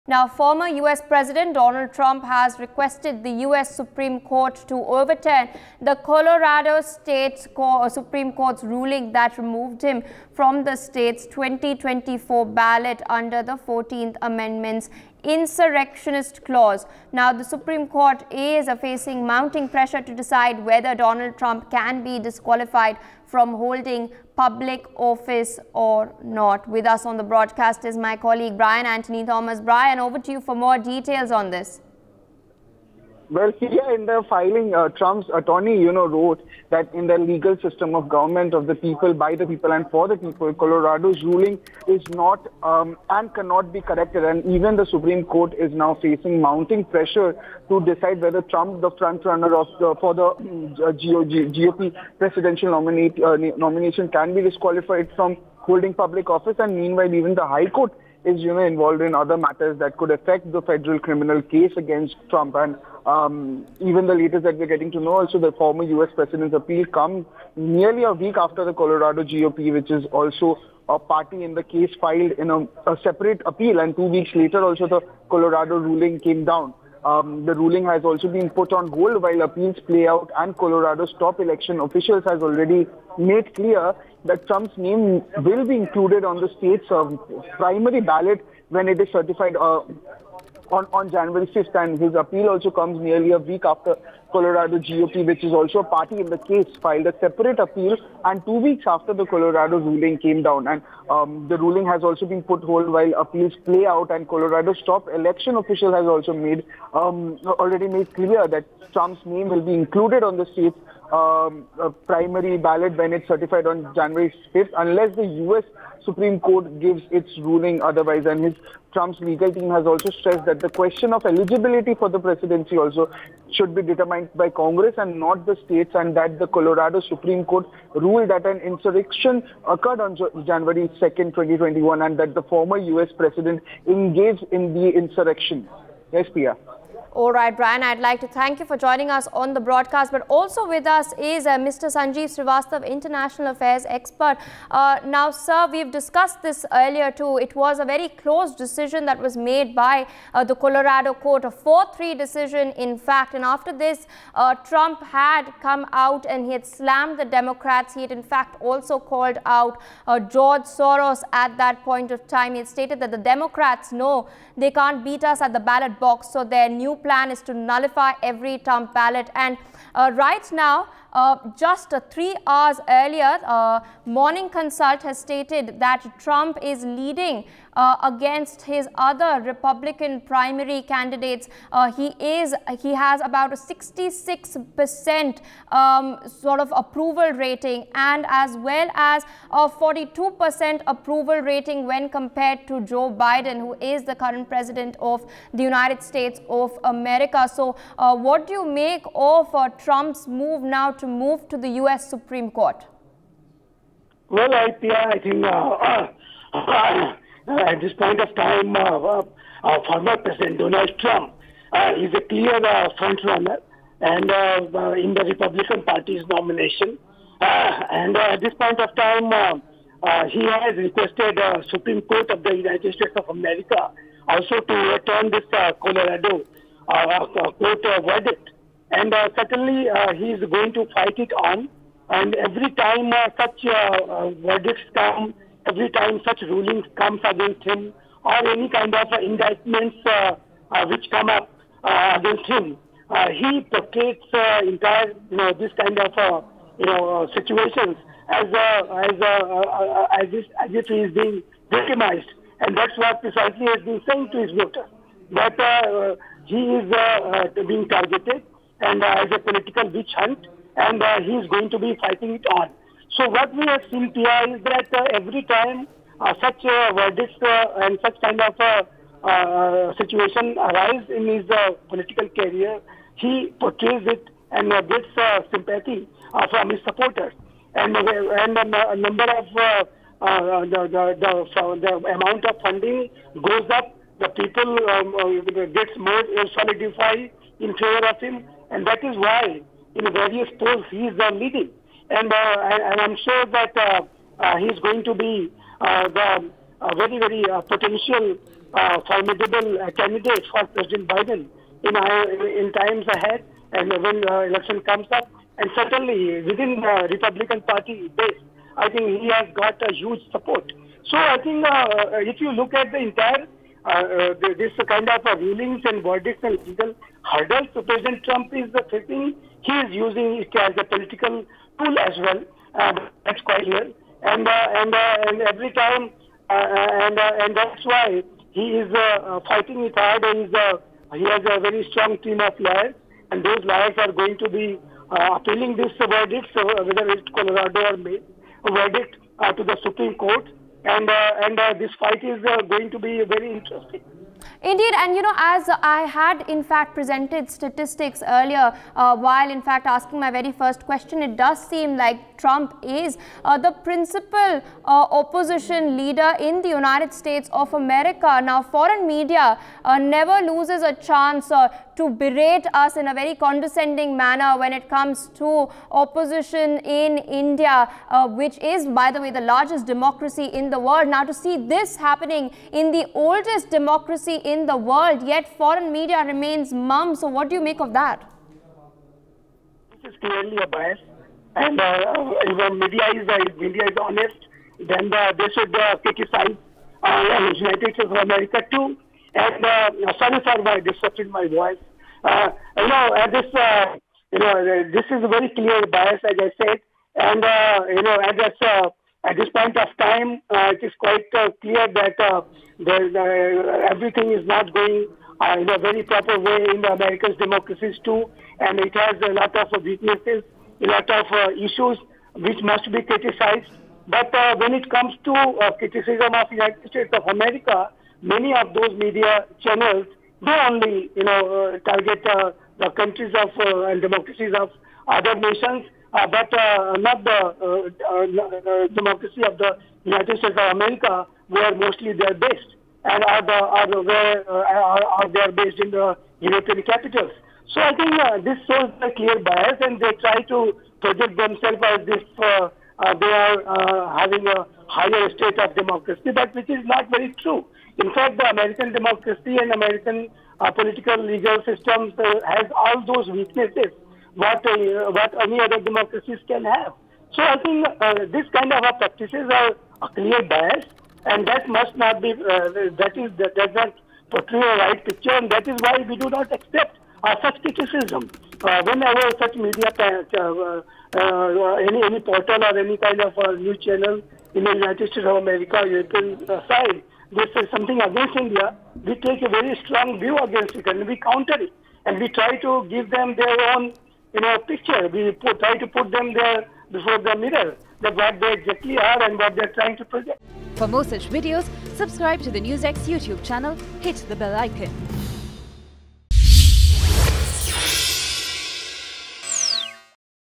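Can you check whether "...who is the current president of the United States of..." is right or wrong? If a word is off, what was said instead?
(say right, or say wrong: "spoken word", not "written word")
right.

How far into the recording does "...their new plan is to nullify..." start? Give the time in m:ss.
2:46.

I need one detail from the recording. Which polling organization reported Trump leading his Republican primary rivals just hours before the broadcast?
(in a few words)
Morning Consult.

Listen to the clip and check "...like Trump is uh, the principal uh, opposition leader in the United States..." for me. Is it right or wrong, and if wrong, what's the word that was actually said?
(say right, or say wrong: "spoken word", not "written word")
right.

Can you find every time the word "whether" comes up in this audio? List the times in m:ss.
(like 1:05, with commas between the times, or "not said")
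0:20, 0:48, 5:36.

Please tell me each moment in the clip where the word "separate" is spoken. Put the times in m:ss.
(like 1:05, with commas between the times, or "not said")
1:13, 1:37.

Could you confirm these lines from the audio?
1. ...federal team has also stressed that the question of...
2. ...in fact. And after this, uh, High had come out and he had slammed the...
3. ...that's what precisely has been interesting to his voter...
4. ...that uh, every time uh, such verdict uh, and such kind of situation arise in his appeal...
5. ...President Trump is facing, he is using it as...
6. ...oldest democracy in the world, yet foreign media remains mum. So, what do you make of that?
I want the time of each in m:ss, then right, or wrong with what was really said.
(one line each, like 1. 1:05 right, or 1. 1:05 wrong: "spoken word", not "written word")
1. 1:59 wrong: "legal", not "federal"
2. 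2:32 wrong: "Trump", not "High"
3. 4:12 wrong: "saying", not "interesting"
4. 4:24 wrong: "political", not "appeal"
5. 5:17 right
6. 6:13 right.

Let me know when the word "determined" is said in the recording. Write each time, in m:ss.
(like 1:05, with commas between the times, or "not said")
2:03.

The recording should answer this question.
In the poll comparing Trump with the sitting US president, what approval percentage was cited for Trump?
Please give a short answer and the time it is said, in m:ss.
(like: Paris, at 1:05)
42 percent, at 3:09.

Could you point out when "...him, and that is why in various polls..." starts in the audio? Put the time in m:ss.
4:48.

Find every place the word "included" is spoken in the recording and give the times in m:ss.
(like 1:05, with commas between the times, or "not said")
1:25, 1:49.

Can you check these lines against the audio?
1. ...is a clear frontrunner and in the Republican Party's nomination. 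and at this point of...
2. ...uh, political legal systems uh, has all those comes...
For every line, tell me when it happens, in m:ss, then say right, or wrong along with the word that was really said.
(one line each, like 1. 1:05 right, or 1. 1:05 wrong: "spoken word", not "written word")
1. 3:31 right
2. 7:30 wrong: "weaknesses", not "comes".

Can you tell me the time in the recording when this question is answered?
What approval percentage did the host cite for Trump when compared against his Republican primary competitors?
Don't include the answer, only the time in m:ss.
3:03.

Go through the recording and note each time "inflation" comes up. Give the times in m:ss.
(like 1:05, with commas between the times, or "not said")
not said.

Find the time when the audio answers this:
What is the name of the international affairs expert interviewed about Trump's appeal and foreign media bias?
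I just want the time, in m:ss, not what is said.
2:21.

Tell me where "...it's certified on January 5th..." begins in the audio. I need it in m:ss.
1:53.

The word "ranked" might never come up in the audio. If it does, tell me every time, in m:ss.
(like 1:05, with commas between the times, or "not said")
2:04.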